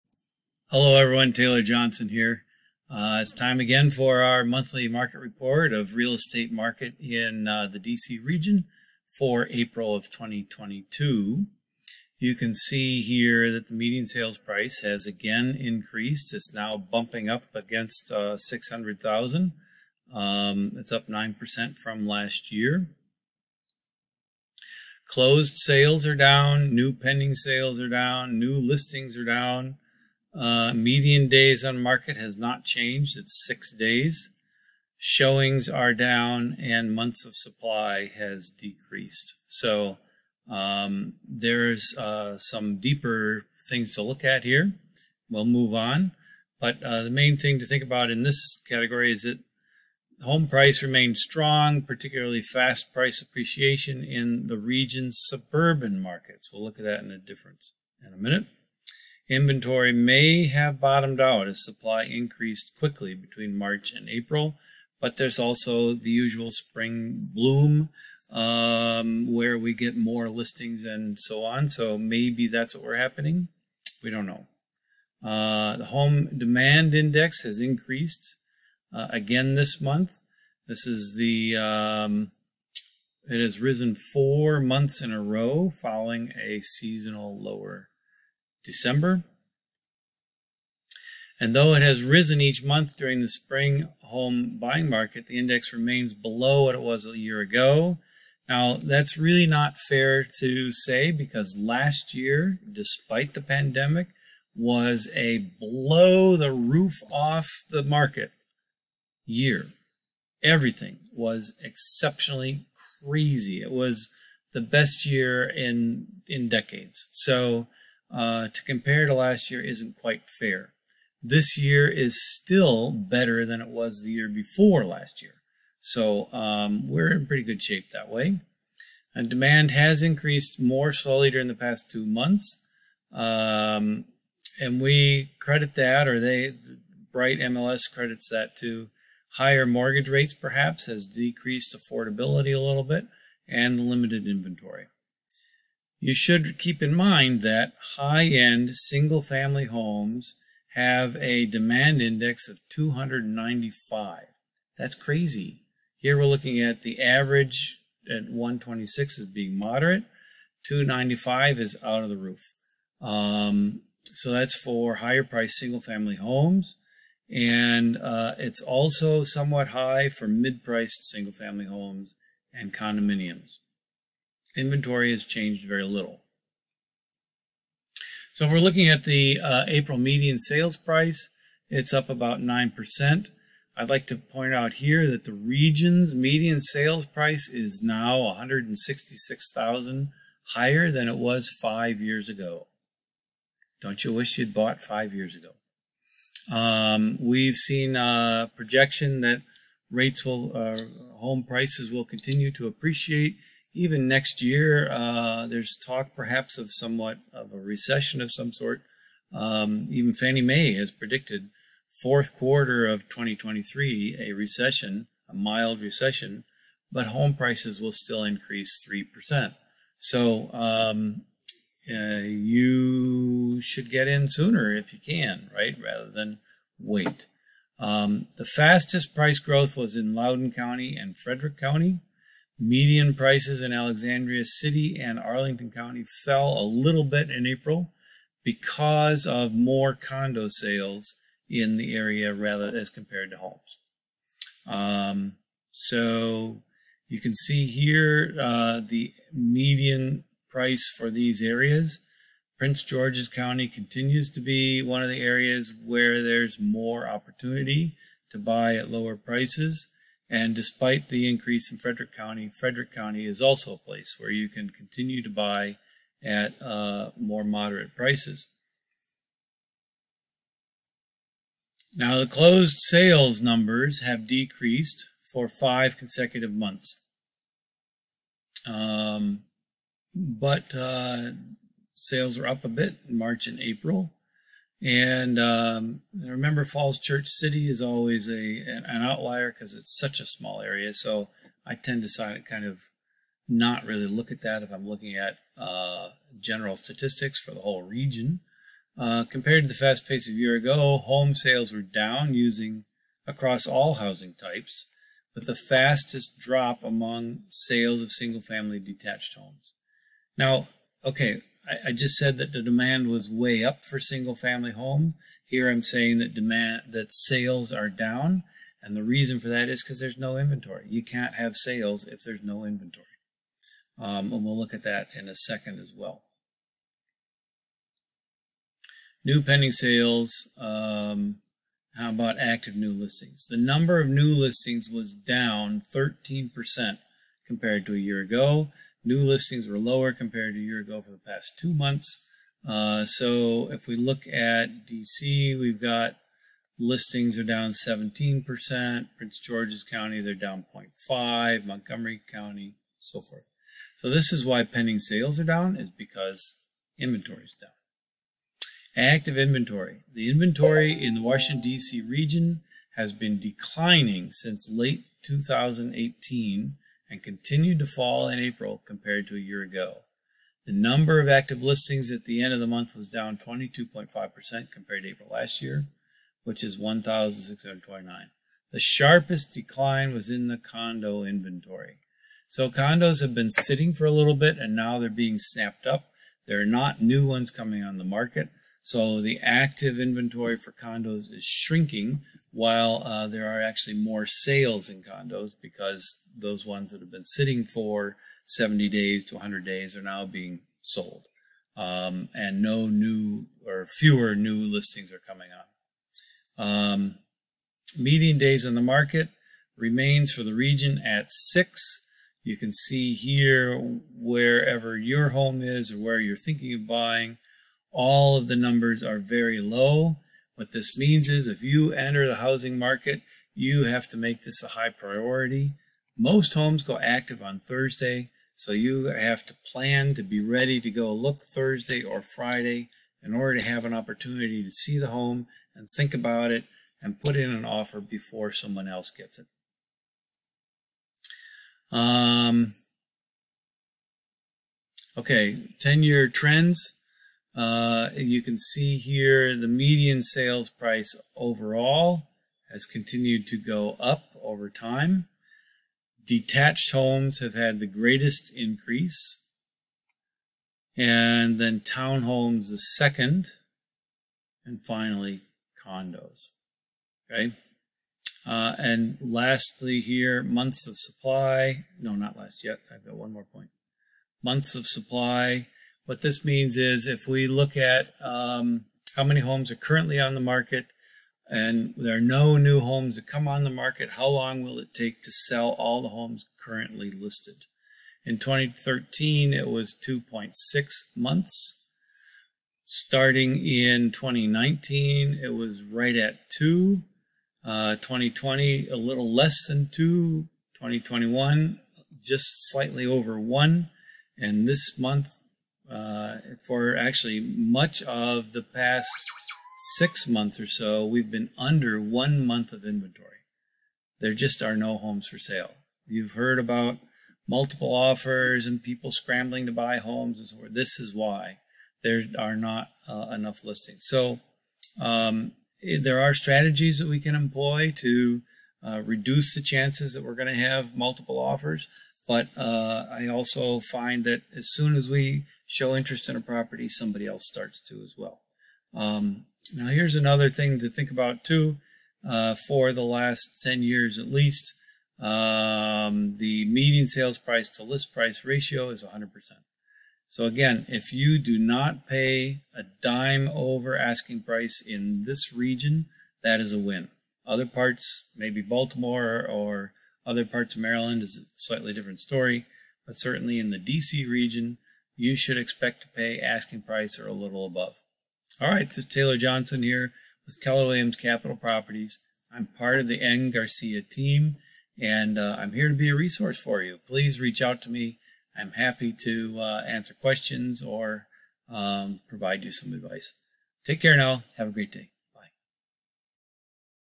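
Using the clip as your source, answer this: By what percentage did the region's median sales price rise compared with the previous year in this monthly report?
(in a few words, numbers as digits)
9%.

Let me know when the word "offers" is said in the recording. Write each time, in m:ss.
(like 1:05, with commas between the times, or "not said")
7:17, 8:37, 8:51.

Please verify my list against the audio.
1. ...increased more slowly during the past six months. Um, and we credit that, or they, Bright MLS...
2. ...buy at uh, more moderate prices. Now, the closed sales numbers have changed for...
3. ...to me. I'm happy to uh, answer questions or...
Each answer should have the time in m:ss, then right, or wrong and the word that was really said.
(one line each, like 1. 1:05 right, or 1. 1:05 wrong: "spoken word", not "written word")
1. 2:10 wrong: "two", not "six"
2. 4:25 wrong: "decreased", not "changed"
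3. 9:37 right.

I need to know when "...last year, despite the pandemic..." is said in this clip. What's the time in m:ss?
1:41.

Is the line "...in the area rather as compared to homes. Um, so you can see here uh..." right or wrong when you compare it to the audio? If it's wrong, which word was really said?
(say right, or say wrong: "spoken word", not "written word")
right.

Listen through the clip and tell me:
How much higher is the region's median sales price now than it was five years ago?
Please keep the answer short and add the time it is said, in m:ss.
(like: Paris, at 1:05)
$166,000, at 3:08.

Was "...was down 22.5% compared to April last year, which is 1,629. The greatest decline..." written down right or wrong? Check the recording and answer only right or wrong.
wrong.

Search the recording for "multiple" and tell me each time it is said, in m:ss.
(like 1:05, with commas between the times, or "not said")
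8:37, 8:50.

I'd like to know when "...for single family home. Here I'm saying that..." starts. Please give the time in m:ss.
5:13.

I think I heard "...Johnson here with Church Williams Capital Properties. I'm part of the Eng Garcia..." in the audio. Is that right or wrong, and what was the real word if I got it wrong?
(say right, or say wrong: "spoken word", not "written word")
wrong: "Keller", not "Church".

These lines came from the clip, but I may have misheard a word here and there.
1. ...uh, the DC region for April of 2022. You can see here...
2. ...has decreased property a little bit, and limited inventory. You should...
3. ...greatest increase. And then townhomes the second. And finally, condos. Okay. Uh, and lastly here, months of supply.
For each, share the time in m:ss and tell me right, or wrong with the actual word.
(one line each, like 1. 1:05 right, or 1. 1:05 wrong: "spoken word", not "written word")
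1. 0:07 right
2. 2:20 wrong: "affordability", not "property"
3. 7:37 right.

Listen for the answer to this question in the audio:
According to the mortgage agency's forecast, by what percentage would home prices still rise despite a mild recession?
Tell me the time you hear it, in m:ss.
3:39.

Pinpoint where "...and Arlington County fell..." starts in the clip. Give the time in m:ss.
3:55.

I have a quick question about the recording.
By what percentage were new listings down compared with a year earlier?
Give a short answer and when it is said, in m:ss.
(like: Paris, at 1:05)
13%, at 5:35.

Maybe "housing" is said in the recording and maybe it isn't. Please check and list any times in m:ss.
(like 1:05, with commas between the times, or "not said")
5:03, 7:02.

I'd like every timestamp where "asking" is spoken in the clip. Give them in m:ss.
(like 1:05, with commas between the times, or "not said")
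9:13, 9:26.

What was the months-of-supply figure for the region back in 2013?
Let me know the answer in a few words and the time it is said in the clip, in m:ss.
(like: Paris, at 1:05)
2.6 months, at 8:10.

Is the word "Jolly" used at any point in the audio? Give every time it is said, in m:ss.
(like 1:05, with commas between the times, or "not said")
not said.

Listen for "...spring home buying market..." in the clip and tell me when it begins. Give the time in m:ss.
1:33.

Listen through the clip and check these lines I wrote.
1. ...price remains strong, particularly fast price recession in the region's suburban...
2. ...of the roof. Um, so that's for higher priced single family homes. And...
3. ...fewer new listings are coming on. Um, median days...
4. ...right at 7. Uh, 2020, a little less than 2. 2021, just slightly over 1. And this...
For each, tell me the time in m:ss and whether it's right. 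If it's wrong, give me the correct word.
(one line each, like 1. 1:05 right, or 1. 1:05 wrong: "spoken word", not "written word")
1. 0:50 wrong: "appreciation", not "recession"
2. 2:42 right
3. 6:43 right
4. 8:15 wrong: "2", not "7".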